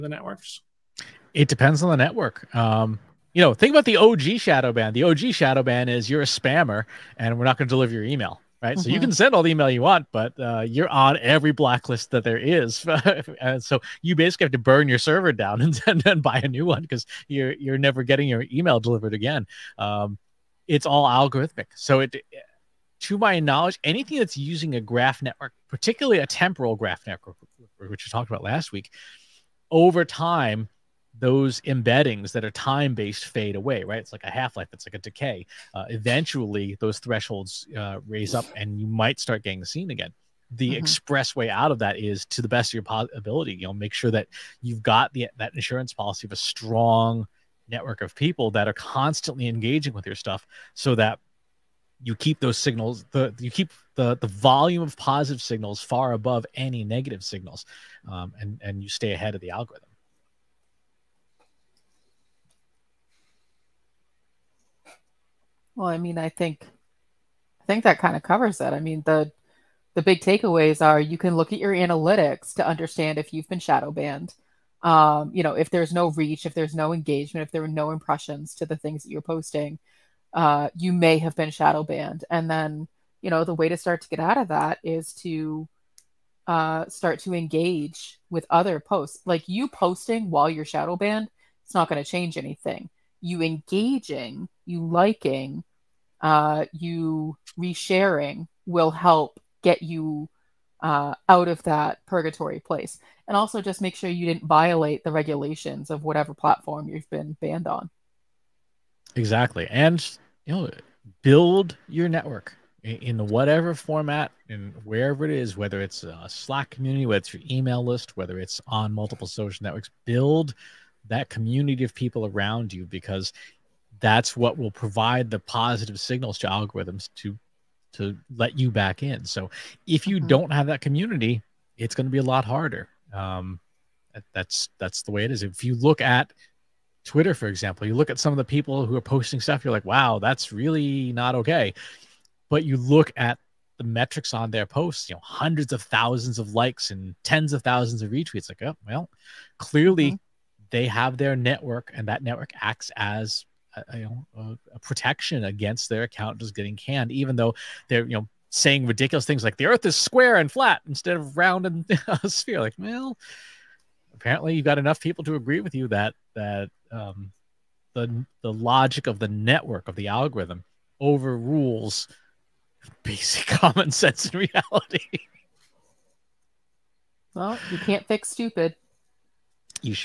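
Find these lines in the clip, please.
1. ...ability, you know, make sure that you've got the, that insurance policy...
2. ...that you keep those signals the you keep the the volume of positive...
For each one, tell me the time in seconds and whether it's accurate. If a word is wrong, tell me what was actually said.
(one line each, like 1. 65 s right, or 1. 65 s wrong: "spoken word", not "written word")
1. 43 s right
2. 50 s right.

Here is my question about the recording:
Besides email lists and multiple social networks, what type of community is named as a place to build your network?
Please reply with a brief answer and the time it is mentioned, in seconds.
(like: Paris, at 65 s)
Slack community, at 116 s.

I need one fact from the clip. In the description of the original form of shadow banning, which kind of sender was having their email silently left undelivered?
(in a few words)
A spammer.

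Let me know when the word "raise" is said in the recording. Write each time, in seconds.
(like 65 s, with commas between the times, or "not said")
38 s.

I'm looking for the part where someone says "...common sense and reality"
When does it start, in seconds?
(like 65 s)
173 s.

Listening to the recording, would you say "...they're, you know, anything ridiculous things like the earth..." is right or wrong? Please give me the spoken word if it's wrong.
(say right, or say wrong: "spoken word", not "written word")
wrong: "saying", not "anything".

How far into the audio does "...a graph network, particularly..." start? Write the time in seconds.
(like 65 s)
24 s.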